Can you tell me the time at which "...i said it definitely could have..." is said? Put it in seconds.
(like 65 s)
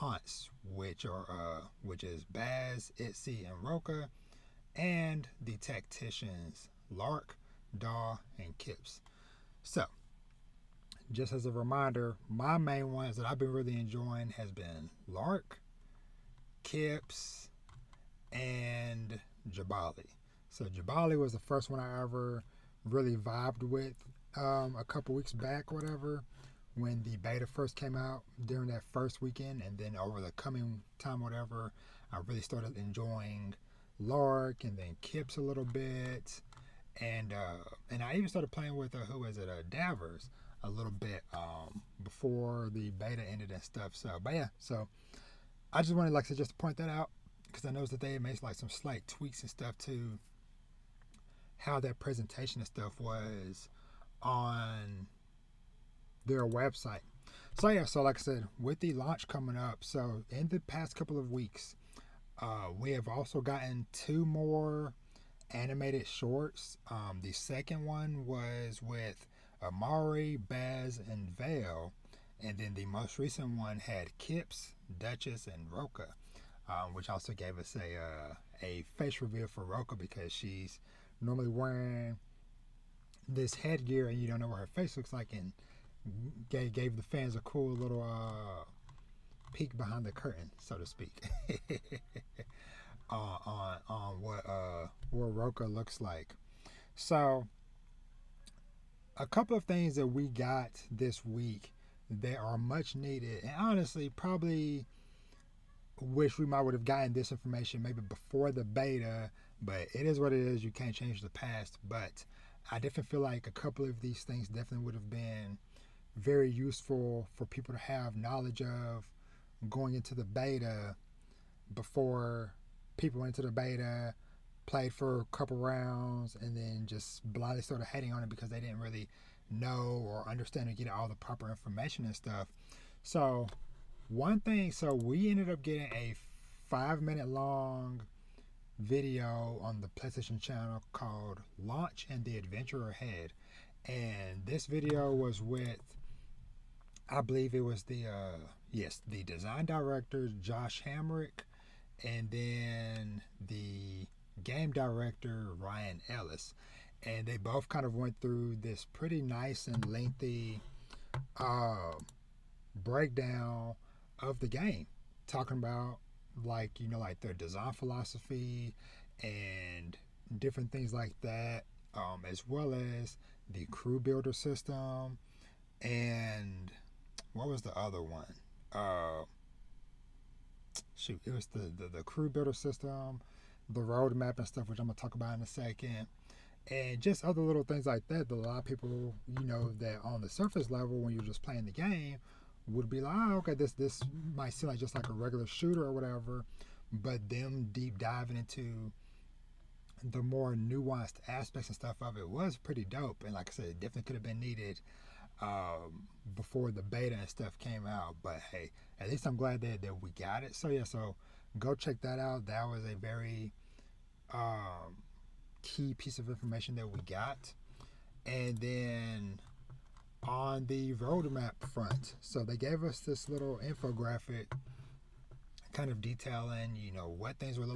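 203 s.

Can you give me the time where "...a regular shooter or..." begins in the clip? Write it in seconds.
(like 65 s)
195 s.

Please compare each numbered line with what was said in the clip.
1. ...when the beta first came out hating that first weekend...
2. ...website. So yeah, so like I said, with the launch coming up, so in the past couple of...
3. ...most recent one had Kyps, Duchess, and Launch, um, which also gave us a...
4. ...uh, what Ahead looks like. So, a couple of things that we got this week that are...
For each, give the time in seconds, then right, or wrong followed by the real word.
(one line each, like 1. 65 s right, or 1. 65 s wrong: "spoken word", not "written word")
1. 26 s wrong: "during", not "hating"
2. 56 s right
3. 72 s wrong: "Roka", not "Launch"
4. 94 s wrong: "Roka", not "Ahead".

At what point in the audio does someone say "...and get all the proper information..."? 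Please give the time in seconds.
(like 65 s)
130 s.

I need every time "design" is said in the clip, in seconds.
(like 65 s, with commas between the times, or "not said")
149 s, 167 s.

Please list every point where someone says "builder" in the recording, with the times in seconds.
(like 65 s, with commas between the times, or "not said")
173 s, 182 s.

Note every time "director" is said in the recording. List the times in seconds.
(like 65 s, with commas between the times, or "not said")
149 s, 154 s.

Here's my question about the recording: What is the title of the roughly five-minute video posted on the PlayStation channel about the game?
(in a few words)
Launch and the Adventure Ahead.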